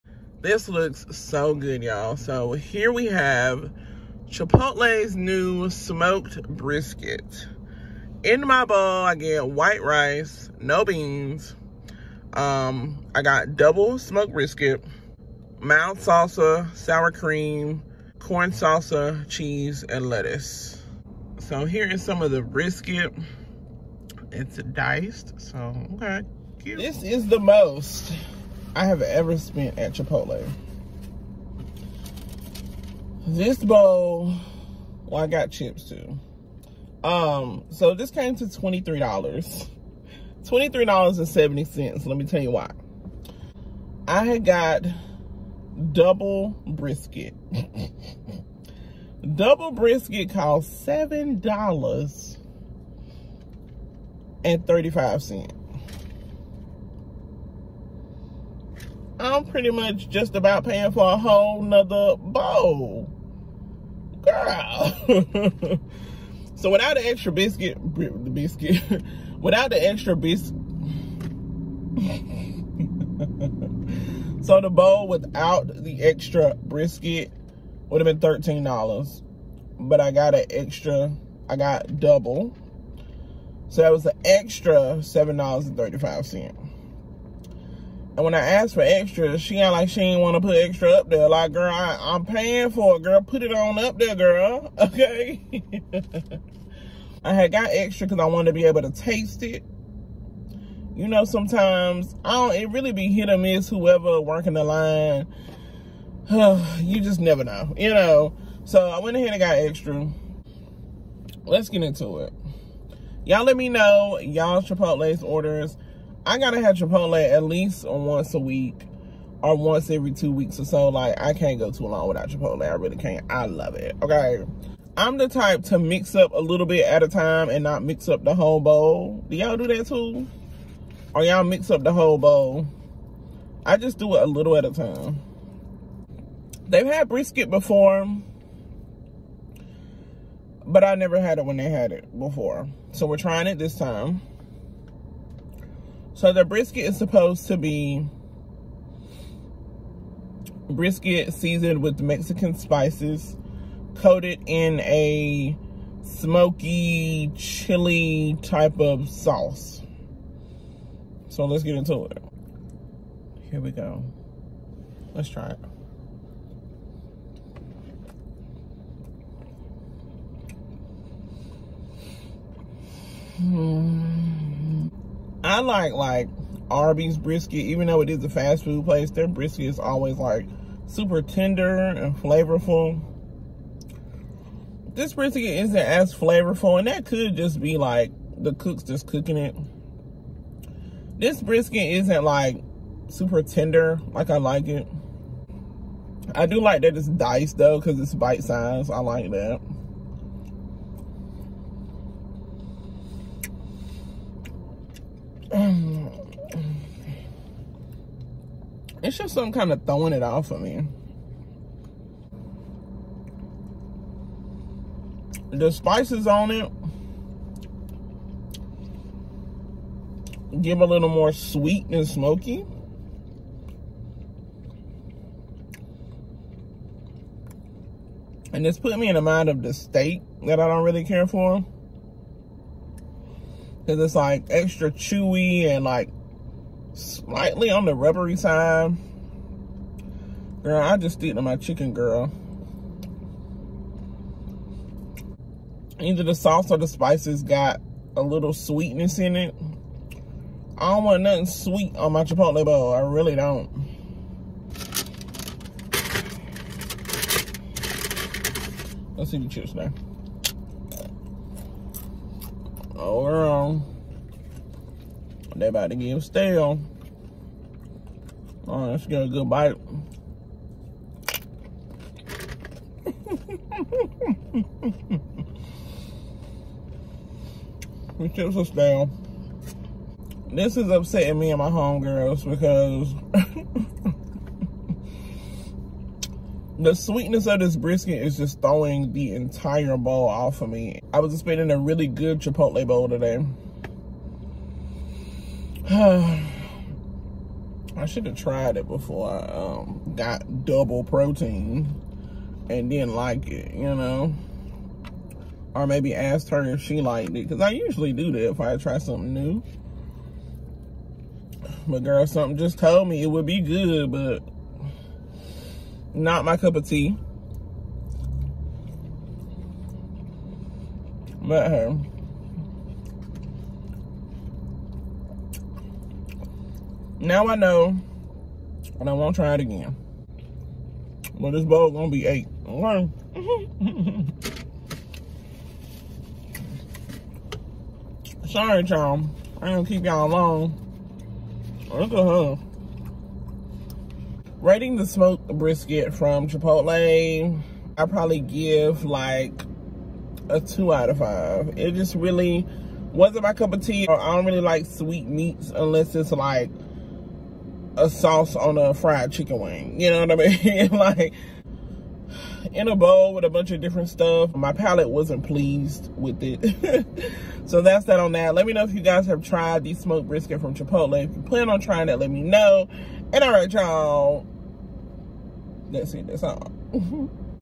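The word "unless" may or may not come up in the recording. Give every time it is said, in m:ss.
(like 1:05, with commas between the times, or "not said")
5:55.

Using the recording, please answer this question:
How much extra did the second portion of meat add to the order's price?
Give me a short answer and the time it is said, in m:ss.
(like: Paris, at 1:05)
$7.35, at 0:50.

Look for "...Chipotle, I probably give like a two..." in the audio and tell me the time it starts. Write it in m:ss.
5:46.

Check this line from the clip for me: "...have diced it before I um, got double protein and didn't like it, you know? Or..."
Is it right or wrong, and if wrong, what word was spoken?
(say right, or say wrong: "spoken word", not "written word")
wrong: "tried", not "diced".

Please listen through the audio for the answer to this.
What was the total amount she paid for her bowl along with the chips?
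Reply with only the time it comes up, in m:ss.
0:40.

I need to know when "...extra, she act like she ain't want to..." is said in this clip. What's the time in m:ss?
1:28.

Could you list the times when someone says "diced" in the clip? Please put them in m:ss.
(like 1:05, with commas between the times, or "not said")
0:24, 3:17.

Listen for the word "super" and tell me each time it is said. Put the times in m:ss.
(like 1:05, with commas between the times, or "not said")
3:00, 3:13.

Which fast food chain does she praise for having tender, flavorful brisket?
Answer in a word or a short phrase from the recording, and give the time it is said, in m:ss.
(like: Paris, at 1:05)
Arby's, at 2:56.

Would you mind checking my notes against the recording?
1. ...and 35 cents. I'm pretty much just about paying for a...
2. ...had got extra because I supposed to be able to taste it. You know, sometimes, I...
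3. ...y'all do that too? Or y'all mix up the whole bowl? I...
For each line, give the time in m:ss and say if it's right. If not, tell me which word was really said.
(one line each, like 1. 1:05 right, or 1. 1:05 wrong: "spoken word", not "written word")
1. 0:54 right
2. 1:37 wrong: "wanted", not "supposed"
3. 2:09 right.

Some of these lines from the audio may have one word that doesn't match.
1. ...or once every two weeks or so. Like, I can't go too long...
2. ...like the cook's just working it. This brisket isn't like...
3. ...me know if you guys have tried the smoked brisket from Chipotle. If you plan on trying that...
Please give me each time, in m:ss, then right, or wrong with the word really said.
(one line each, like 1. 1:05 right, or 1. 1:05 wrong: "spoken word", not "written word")
1. 1:59 right
2. 3:07 wrong: "cooking", not "working"
3. 6:08 right.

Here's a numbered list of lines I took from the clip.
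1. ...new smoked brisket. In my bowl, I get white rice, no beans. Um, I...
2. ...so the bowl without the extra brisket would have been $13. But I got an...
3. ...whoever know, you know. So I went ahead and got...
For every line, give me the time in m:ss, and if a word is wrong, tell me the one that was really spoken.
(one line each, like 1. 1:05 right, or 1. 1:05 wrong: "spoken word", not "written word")
1. 0:05 right
2. 1:14 right
3. 1:47 wrong: "never", not "whoever".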